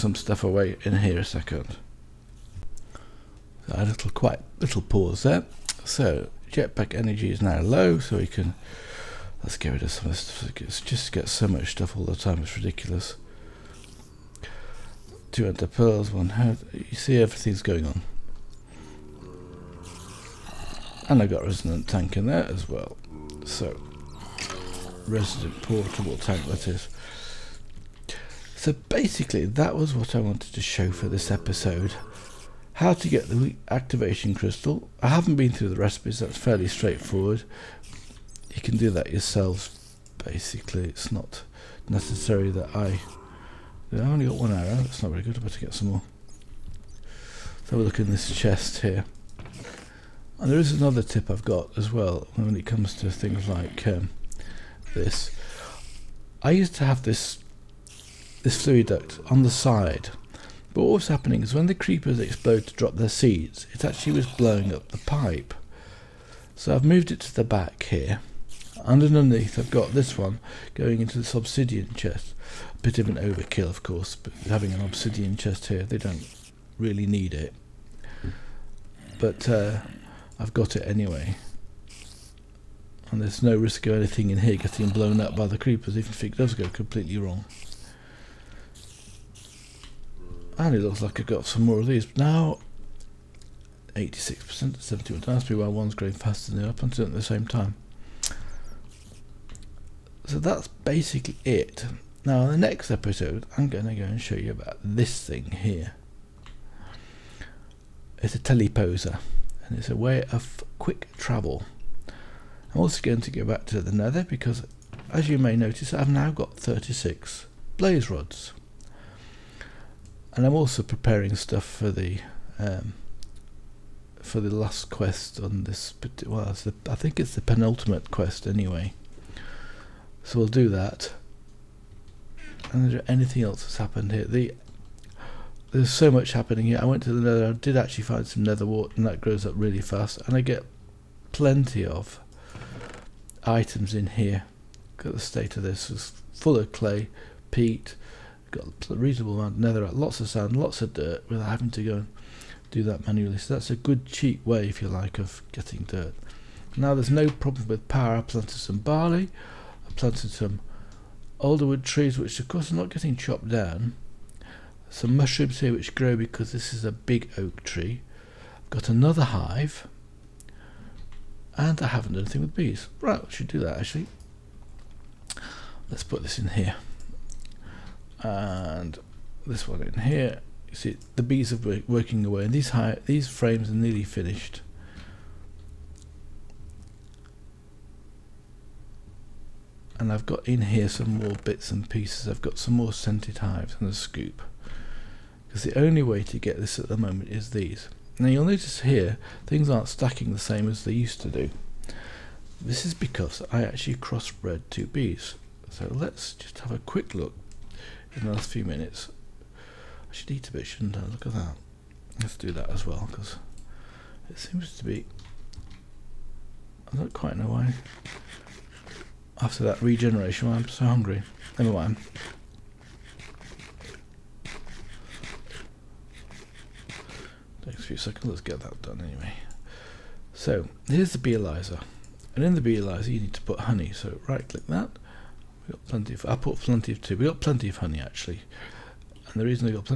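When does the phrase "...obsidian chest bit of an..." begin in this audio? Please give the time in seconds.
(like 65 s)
71 s.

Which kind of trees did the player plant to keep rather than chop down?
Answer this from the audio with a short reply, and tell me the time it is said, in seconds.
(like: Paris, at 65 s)
alderwood, at 161 s.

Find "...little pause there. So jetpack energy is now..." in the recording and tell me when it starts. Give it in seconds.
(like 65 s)
4 s.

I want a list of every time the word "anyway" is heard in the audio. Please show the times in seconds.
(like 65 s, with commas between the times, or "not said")
80 s, 128 s, 229 s.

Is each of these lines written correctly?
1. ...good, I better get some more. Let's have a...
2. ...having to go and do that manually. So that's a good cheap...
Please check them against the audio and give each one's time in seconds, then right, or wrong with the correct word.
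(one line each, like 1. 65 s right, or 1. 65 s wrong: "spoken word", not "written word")
1. 45 s right
2. 151 s right.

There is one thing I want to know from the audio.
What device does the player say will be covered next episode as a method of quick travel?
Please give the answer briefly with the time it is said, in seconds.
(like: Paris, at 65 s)
teleposer, at 108 s.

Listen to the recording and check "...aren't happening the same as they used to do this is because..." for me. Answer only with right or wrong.
wrong.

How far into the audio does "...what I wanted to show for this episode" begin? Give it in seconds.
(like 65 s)
29 s.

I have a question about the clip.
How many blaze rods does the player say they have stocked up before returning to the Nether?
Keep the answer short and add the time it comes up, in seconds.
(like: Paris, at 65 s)
36, at 116 s.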